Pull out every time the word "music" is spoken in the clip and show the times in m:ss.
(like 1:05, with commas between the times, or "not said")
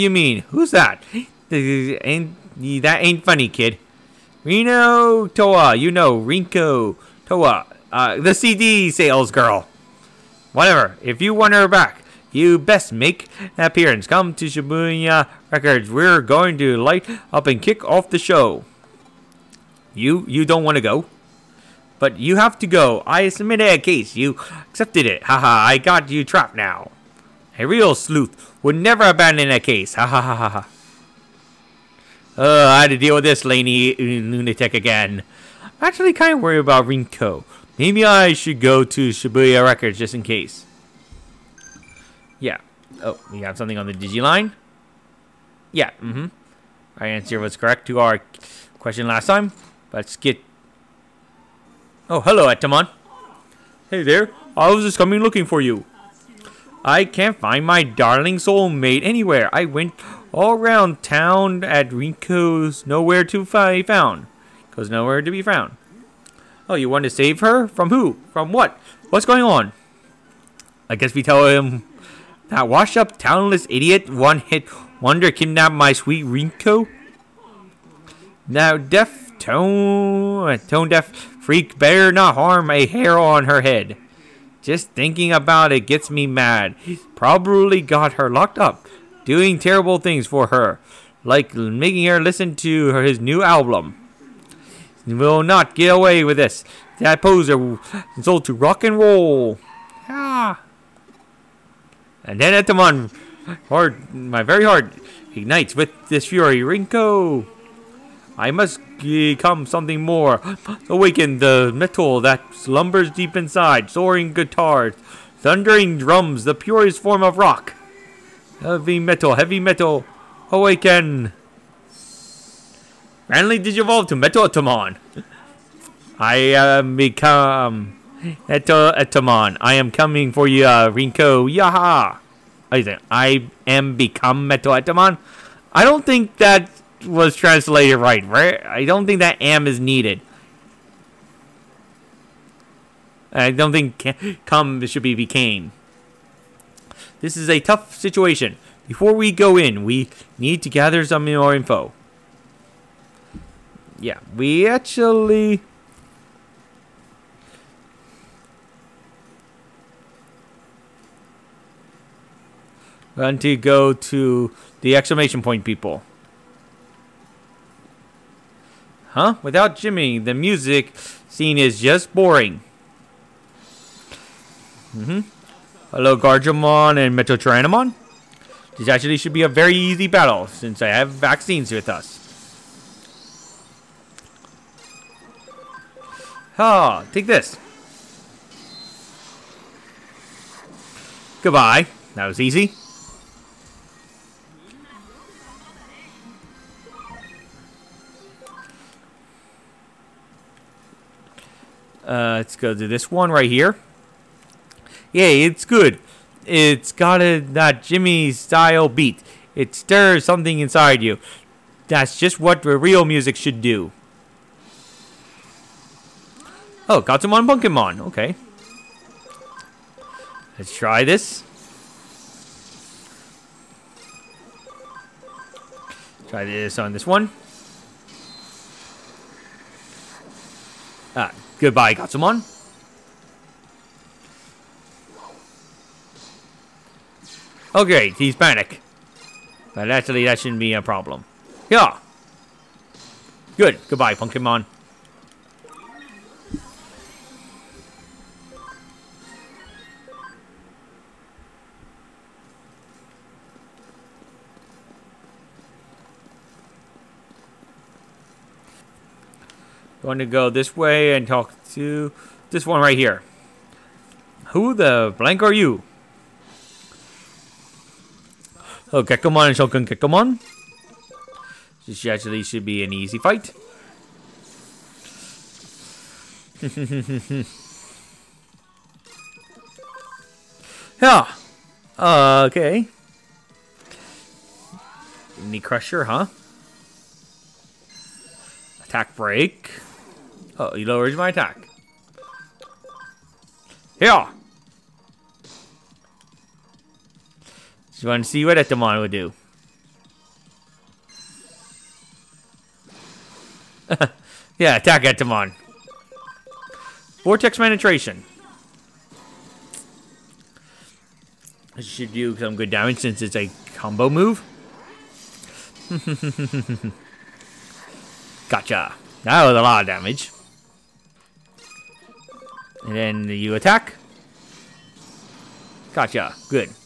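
2:50, 3:33.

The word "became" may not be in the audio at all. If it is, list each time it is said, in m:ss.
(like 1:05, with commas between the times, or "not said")
2:25.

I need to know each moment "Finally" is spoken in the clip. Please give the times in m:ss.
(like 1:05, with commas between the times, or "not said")
2:03.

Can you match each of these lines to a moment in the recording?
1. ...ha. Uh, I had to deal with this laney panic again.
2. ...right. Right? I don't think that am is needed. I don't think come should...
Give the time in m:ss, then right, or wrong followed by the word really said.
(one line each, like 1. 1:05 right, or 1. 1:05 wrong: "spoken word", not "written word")
1. 0:30 wrong: "lunatic", not "panic"
2. 2:17 right.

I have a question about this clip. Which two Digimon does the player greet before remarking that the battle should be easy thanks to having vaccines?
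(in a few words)
Gargomon and MetalTyrannomon.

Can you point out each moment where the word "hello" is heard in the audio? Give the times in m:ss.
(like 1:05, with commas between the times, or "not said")
0:52, 2:55.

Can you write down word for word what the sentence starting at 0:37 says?
Maybe I should go to Shibuya Records just in case.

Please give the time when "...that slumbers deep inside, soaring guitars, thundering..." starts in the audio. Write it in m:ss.
1:52.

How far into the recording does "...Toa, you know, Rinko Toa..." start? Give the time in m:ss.
0:05.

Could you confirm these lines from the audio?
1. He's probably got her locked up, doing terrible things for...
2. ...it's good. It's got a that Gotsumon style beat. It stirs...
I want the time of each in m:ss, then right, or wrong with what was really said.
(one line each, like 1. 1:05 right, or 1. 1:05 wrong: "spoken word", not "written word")
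1. 1:26 right
2. 3:25 wrong: "Jimmy", not "Gotsumon".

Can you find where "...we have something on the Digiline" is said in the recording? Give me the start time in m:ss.
0:43.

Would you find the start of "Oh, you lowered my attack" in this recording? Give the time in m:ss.
4:50.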